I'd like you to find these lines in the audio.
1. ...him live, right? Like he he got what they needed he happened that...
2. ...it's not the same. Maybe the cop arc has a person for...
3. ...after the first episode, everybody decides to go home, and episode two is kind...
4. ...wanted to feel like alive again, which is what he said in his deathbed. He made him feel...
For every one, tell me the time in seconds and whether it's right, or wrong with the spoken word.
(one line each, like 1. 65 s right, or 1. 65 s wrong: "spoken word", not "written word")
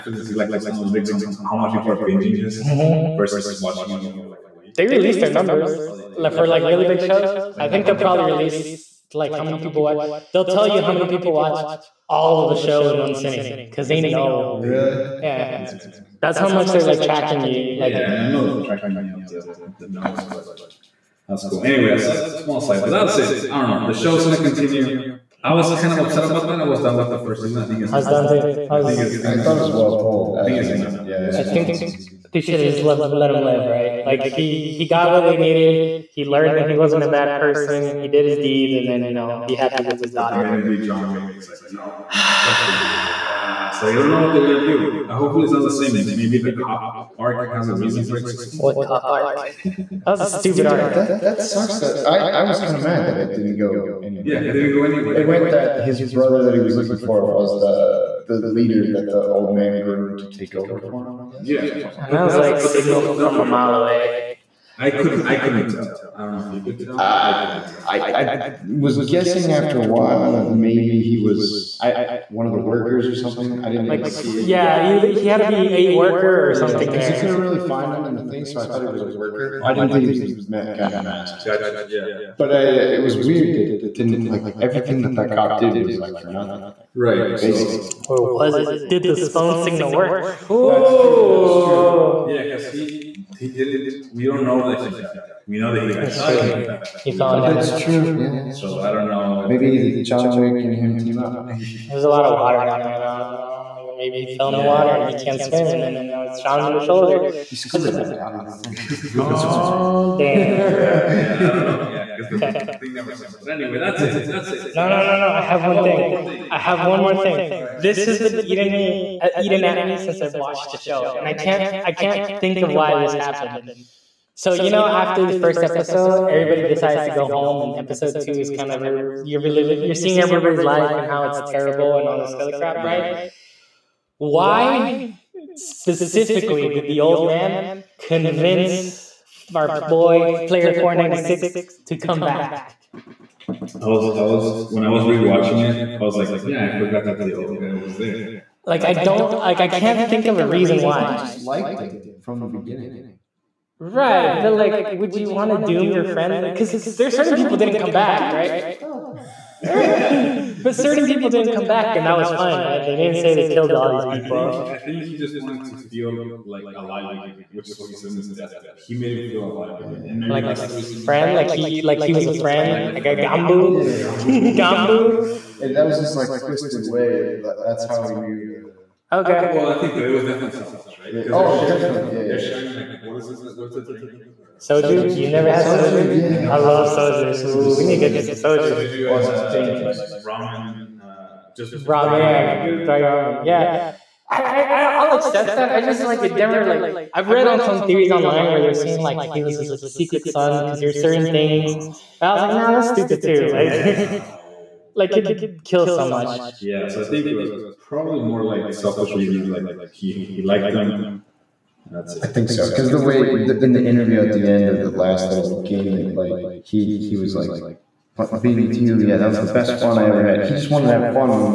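1. 33 s wrong: "learned", not "happened"
2. 45 s wrong: "reason", not "person"
3. 124 s right
4. 165 s right.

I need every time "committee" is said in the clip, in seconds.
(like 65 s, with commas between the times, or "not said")
not said.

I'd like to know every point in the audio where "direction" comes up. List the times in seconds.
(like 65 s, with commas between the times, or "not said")
not said.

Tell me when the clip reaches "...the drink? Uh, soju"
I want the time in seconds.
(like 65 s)
183 s.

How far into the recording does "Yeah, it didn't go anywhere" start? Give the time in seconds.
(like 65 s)
54 s.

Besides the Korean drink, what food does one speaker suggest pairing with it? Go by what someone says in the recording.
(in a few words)
dry ramen.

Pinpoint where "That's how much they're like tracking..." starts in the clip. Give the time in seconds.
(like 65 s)
16 s.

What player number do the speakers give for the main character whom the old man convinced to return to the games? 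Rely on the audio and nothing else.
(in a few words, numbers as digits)
496.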